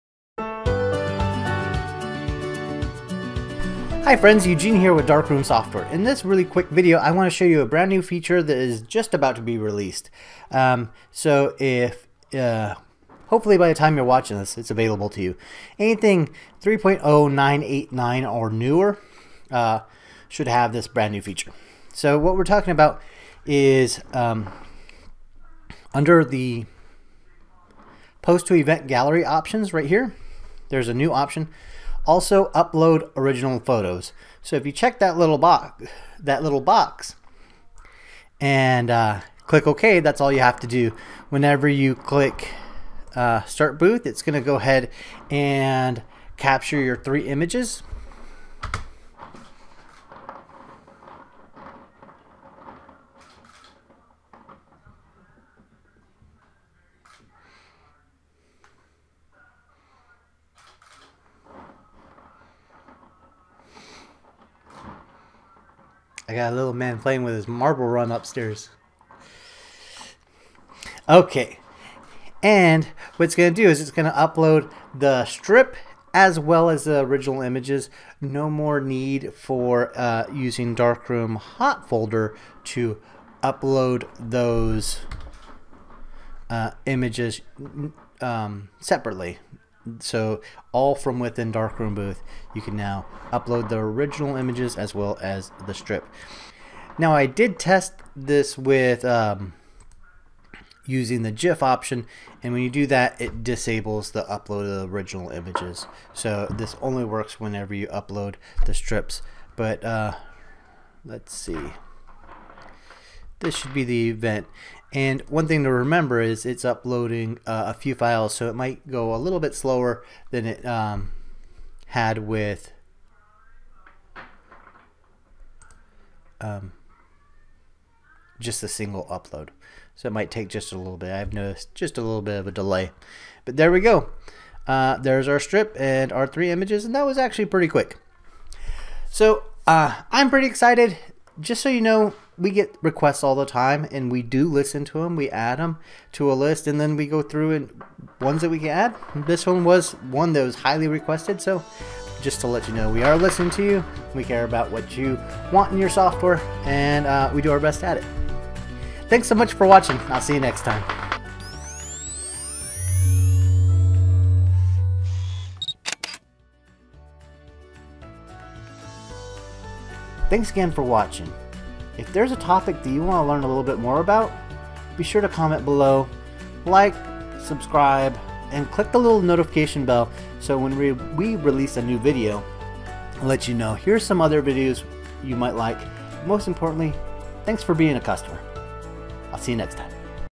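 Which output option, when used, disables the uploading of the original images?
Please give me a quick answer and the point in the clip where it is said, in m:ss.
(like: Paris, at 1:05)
GIF, at 1:41.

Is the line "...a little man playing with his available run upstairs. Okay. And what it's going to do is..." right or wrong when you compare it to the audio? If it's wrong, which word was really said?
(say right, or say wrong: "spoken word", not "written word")
wrong: "marble", not "available".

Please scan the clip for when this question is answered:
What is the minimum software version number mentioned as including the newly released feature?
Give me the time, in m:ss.
0:16.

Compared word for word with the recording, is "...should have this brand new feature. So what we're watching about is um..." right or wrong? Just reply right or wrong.
wrong.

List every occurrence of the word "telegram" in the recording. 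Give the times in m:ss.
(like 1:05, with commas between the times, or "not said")
not said.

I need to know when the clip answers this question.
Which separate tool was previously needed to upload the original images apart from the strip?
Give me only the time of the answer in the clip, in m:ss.
1:20.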